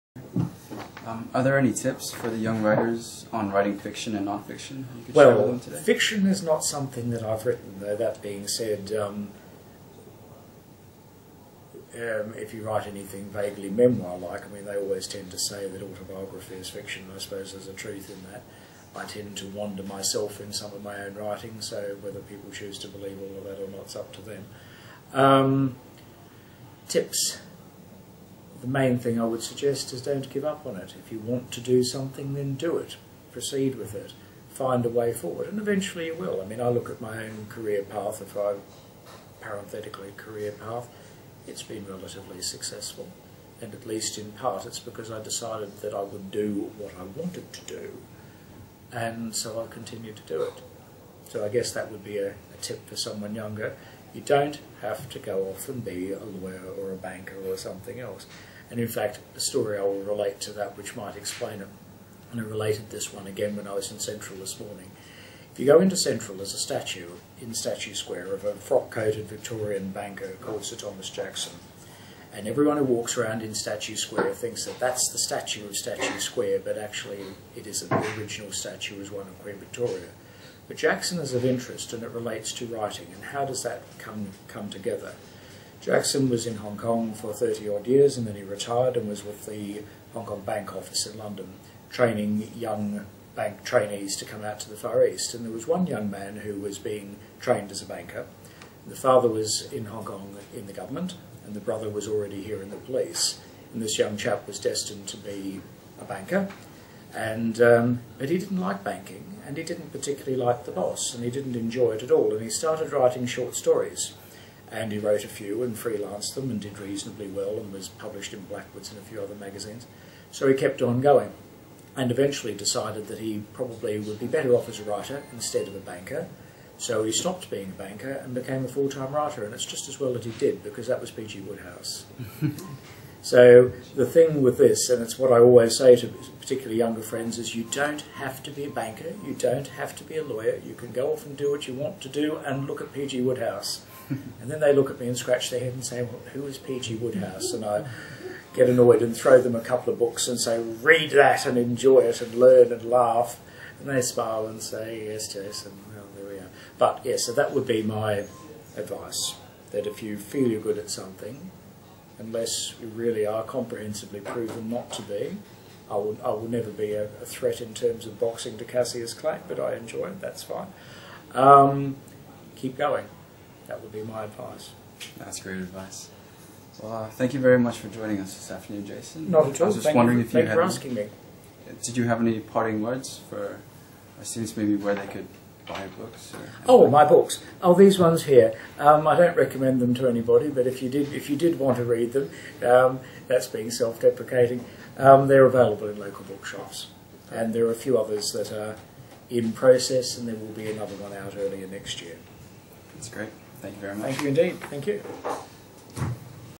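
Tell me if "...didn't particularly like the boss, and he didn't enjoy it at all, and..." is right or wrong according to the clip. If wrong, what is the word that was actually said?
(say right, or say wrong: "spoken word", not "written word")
right.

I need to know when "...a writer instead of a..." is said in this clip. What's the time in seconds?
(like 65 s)
124 s.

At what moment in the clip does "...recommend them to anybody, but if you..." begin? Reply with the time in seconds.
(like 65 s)
189 s.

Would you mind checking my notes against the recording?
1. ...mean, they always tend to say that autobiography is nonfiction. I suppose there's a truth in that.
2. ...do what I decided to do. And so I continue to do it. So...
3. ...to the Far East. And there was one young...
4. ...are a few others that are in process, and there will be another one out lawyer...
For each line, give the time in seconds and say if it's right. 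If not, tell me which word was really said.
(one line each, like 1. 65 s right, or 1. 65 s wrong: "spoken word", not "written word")
1. 14 s wrong: "fiction", not "nonfiction"
2. 46 s wrong: "wanted", not "decided"
3. 94 s right
4. 197 s wrong: "earlier", not "lawyer".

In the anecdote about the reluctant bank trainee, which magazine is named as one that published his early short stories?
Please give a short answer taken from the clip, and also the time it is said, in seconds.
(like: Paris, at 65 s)
Blackwoods, at 118 s.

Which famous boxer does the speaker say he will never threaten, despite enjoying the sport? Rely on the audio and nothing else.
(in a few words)
Cassius Clay.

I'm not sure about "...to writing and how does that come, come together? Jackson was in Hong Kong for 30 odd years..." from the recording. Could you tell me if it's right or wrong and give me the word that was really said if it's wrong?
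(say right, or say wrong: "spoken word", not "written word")
right.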